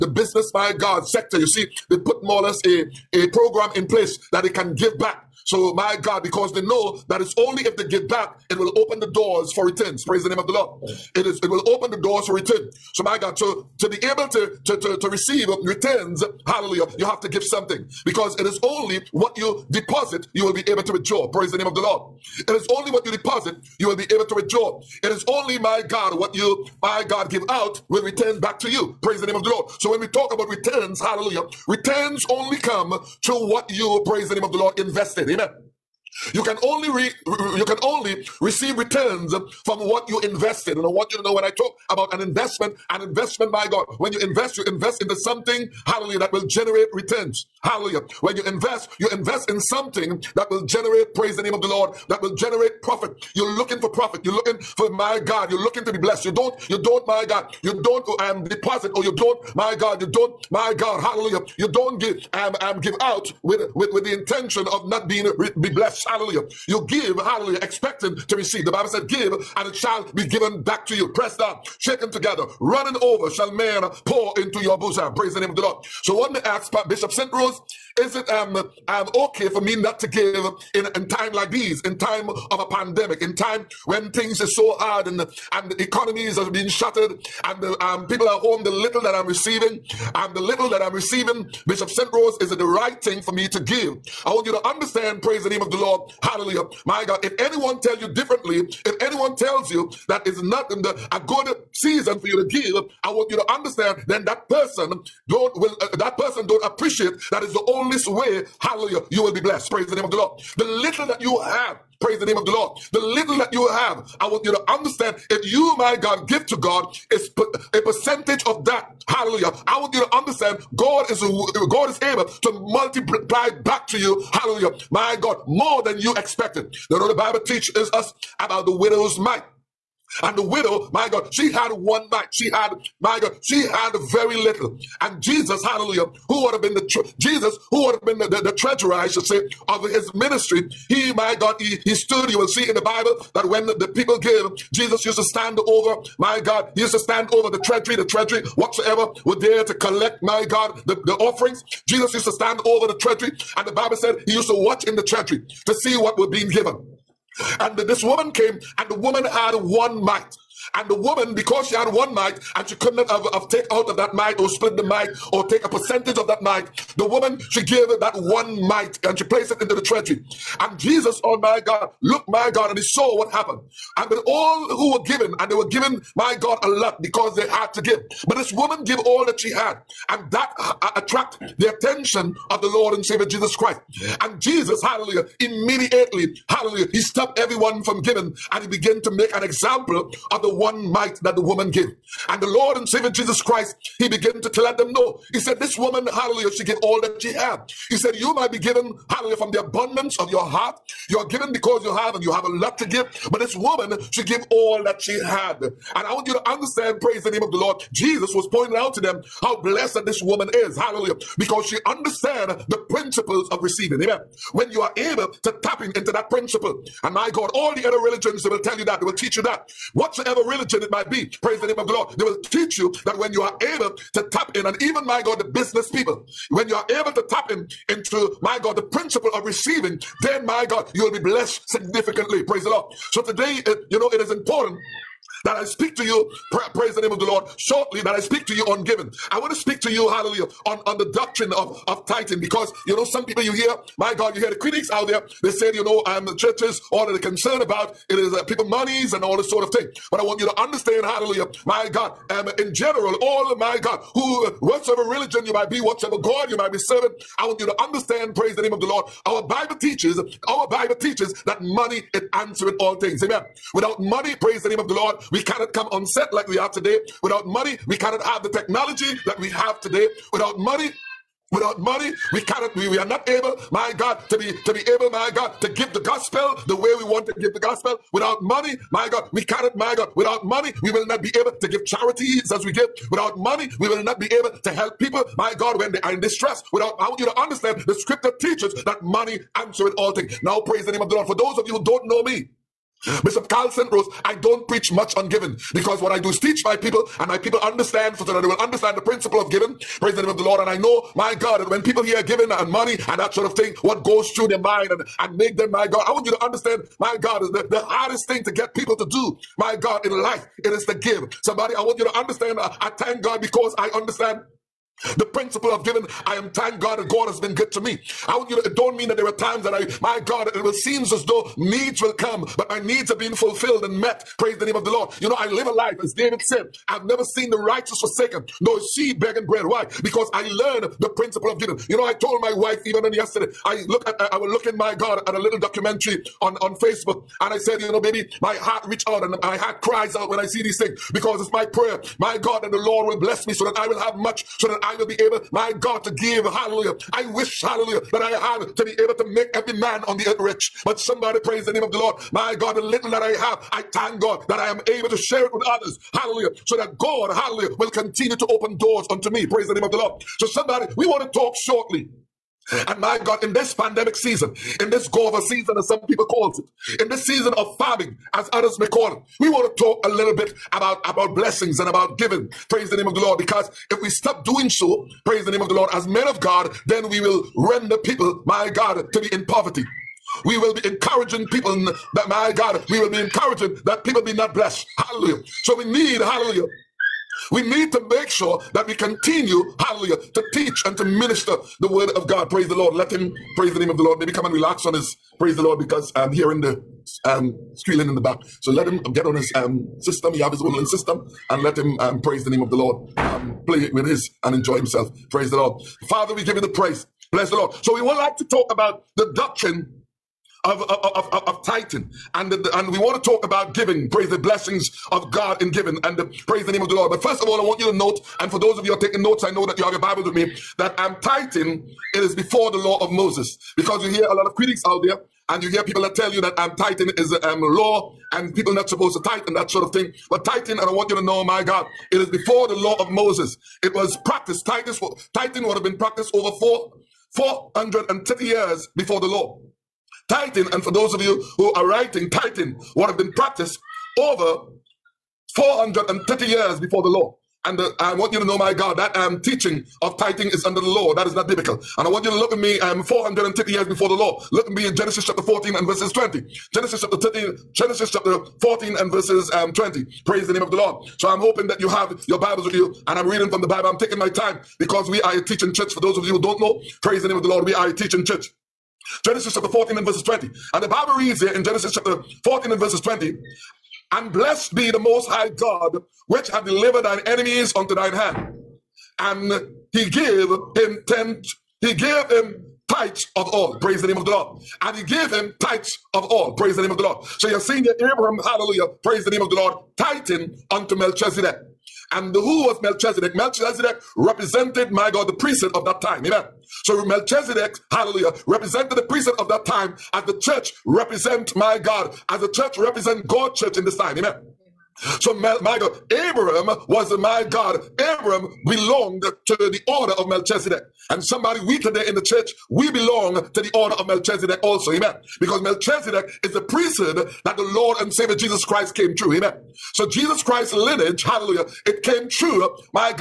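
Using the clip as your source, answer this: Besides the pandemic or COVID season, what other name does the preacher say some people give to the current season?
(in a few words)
Season of farming.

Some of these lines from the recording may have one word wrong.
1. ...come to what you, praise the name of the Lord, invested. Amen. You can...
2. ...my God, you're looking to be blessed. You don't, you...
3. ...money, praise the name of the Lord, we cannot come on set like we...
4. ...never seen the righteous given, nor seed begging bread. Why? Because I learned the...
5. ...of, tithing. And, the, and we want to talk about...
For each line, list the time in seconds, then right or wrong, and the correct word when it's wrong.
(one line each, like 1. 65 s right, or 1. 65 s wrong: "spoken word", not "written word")
1. 32 s right
2. 54 s right
3. 263 s right
4. 327 s wrong: "forsaken", not "given"
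5. 411 s right.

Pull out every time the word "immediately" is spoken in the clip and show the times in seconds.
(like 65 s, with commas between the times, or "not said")
185 s.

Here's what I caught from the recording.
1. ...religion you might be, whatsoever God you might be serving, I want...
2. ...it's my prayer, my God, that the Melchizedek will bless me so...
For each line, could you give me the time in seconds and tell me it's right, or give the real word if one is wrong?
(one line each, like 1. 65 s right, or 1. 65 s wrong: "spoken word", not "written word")
1. 255 s right
2. 341 s wrong: "Lord", not "Melchizedek".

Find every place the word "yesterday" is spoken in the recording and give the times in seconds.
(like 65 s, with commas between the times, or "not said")
333 s.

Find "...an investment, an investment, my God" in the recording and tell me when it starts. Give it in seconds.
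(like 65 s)
42 s.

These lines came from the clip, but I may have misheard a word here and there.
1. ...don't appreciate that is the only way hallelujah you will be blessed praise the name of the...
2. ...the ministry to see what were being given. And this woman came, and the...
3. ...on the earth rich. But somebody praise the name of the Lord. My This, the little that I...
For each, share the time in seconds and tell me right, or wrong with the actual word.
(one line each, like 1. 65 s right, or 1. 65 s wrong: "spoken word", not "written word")
1. 106 s right
2. 154 s wrong: "treasury", not "ministry"
3. 350 s wrong: "God", not "This".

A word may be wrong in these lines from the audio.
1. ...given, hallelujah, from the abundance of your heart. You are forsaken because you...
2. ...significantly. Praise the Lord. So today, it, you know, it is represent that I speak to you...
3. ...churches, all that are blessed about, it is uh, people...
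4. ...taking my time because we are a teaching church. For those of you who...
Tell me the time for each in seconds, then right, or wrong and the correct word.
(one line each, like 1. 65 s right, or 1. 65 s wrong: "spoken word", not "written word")
1. 198 s wrong: "given", not "forsaken"
2. 231 s wrong: "important", not "represent"
3. 246 s wrong: "concerned", not "blessed"
4. 463 s right.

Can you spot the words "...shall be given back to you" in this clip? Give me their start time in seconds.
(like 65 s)
69 s.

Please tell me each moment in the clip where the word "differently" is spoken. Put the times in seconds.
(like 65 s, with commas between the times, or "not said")
98 s.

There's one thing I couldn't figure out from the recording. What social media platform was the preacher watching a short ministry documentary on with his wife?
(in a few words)
Facebook.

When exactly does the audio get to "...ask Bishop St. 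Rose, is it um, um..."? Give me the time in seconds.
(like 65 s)
76 s.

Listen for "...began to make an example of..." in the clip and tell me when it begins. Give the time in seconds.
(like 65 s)
188 s.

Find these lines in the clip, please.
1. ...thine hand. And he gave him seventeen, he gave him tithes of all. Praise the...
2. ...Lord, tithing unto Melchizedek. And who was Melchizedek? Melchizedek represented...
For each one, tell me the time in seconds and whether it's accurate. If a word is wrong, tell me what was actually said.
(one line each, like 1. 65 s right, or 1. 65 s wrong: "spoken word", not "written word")
1. 477 s wrong: "ten", not "seventeen"
2. 489 s right.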